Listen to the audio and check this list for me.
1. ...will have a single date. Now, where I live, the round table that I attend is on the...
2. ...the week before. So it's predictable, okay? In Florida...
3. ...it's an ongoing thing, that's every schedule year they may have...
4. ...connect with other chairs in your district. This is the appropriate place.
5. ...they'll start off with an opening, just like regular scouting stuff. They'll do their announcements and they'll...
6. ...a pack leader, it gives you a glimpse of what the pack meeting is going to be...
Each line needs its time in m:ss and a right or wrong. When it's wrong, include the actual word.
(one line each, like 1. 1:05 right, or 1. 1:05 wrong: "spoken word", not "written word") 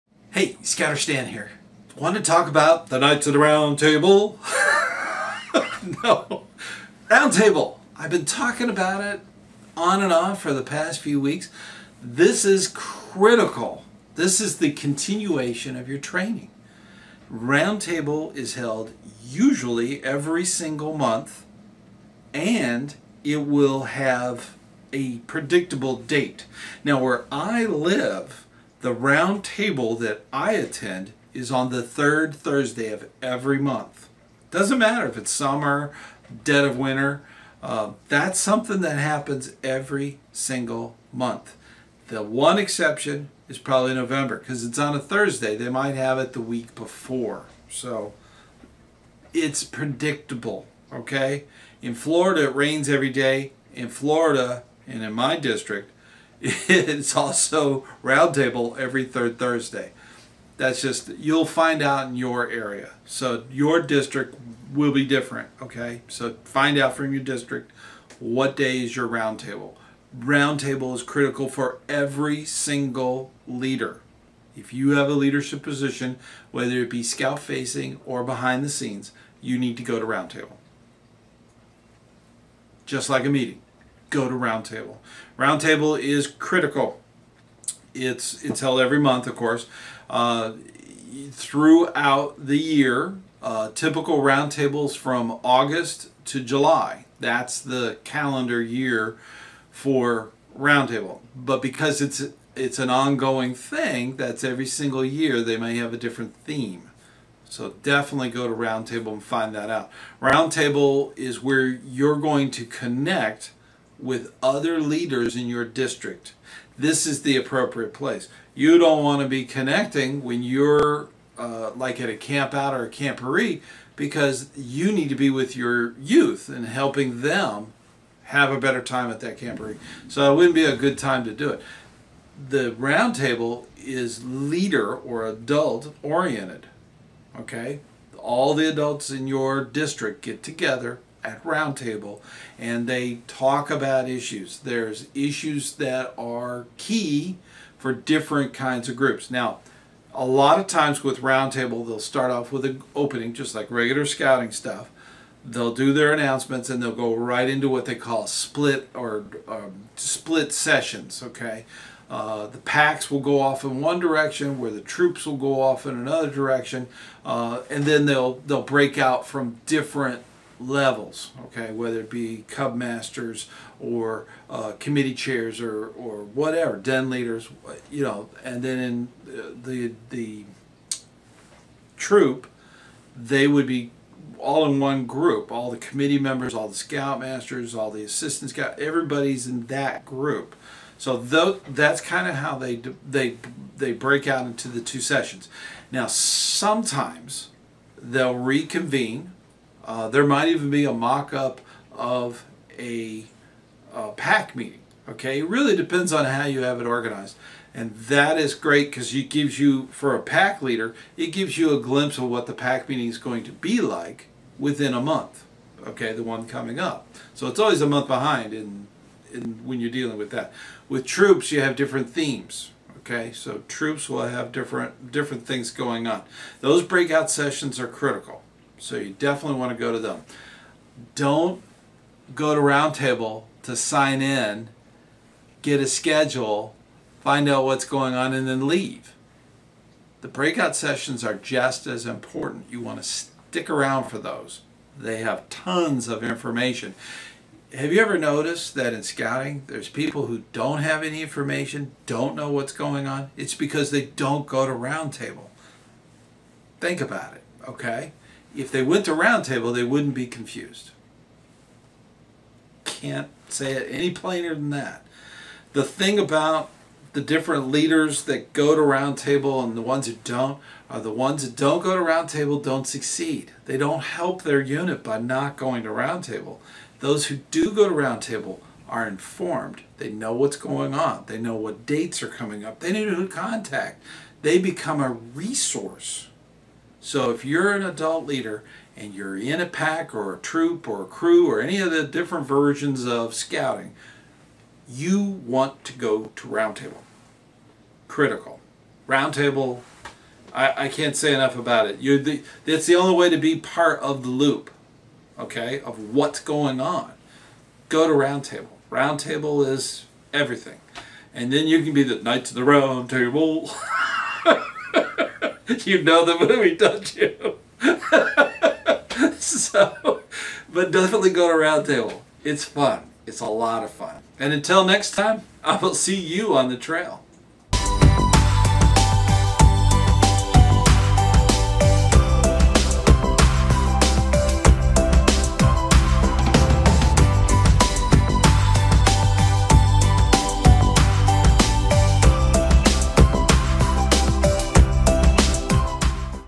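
1. 0:23 wrong: "predictable", not "single"
2. 0:46 right
3. 1:42 wrong: "single", not "schedule"
4. 1:52 wrong: "leaders", not "chairs"
5. 2:31 right
6. 3:30 right.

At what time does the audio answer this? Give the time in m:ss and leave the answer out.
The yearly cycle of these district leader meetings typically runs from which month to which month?
1:35.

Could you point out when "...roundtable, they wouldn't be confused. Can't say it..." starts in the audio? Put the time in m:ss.
4:19.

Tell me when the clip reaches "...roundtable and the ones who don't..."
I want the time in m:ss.
4:28.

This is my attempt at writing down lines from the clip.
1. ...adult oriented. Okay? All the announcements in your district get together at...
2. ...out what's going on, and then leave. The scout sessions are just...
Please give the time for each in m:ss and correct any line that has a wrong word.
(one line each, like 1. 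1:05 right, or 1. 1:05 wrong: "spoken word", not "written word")
1. 2:15 wrong: "adults", not "announcements"
2. 3:57 wrong: "breakout", not "scout".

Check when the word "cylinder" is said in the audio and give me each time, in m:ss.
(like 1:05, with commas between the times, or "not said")
not said.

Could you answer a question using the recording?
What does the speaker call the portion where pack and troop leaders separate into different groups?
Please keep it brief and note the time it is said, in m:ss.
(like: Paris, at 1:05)
split sessions, at 2:39.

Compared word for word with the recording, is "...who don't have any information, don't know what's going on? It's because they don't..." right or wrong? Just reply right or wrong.
right.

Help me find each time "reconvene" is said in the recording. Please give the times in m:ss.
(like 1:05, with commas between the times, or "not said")
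3:18.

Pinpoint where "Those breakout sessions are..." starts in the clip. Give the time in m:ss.
3:46.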